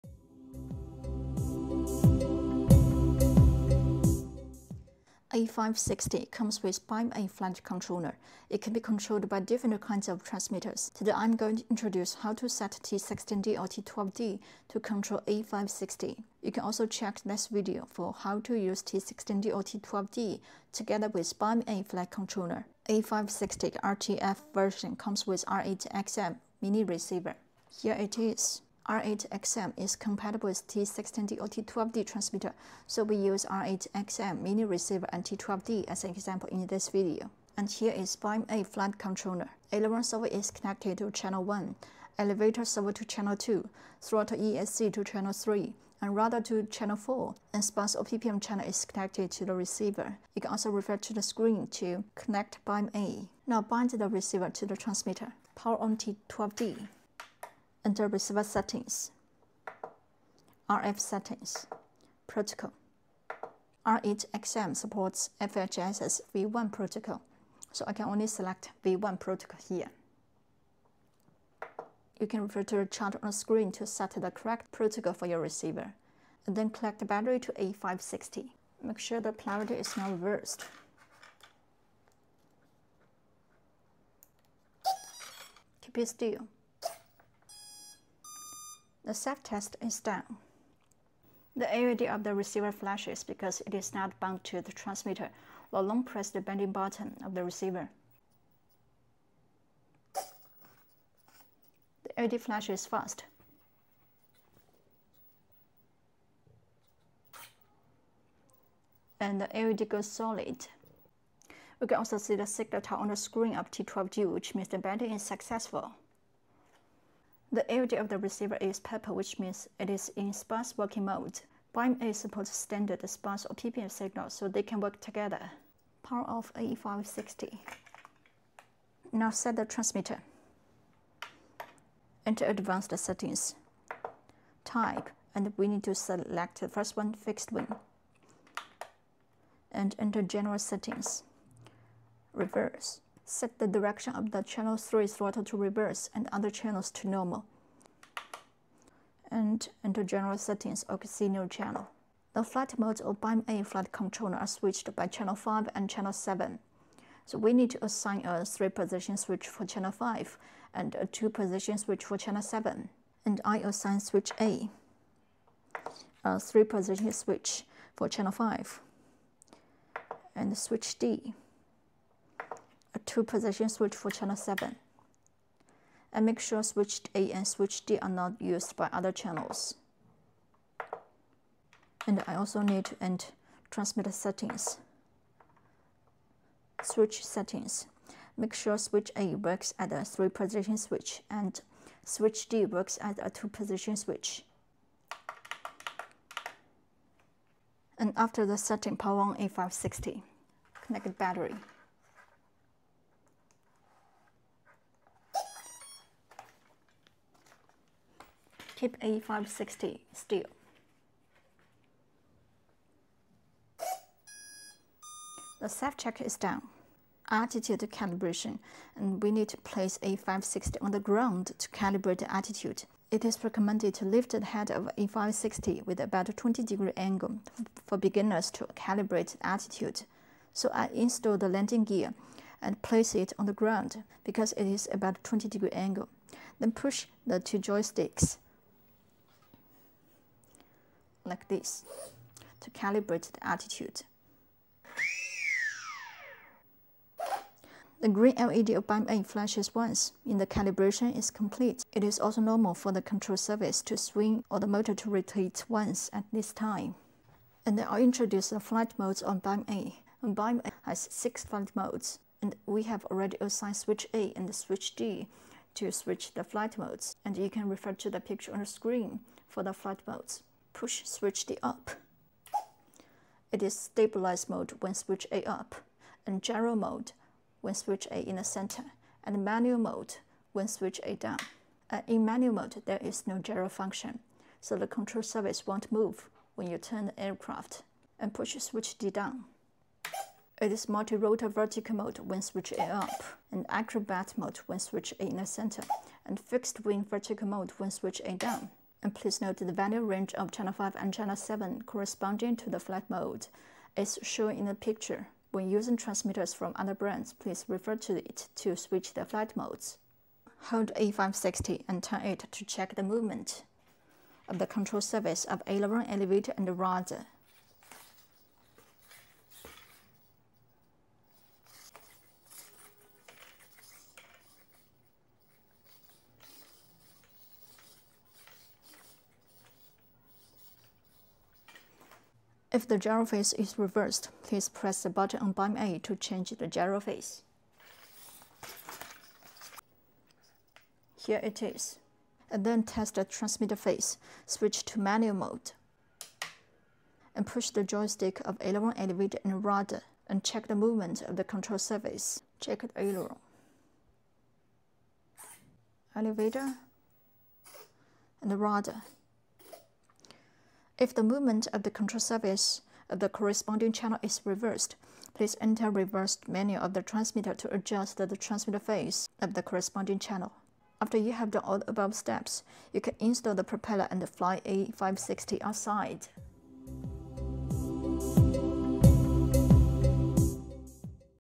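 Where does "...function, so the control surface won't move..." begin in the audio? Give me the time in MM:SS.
04:43.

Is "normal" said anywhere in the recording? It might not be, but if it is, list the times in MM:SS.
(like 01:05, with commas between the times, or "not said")
02:27, 04:12.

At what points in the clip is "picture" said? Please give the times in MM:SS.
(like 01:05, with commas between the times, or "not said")
04:28, 05:04.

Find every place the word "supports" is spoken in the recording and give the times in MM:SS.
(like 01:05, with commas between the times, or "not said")
01:04, 02:02.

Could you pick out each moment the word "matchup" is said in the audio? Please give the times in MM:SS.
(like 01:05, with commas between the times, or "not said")
not said.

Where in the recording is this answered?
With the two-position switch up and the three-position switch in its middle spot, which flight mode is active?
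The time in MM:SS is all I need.
04:36.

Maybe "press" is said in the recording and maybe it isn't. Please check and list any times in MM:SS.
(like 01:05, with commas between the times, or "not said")
01:36, 05:34.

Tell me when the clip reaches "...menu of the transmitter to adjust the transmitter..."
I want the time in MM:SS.
06:06.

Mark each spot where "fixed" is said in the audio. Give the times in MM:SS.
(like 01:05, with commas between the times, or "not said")
02:17, 04:56.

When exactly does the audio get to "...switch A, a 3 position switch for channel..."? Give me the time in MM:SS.
02:44.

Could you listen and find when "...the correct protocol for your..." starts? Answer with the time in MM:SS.
01:14.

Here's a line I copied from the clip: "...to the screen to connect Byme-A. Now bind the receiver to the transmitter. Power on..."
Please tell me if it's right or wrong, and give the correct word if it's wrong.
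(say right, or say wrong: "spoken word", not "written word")
right.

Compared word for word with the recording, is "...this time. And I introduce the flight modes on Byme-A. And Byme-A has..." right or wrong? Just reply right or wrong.
right.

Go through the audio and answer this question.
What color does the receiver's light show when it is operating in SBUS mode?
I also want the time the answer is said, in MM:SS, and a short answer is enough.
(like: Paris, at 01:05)
purple, at 01:58.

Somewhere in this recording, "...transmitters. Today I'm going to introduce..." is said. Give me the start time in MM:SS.
00:10.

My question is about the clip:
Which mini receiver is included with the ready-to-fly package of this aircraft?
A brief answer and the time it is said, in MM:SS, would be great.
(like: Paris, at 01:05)
R8XM, at 00:25.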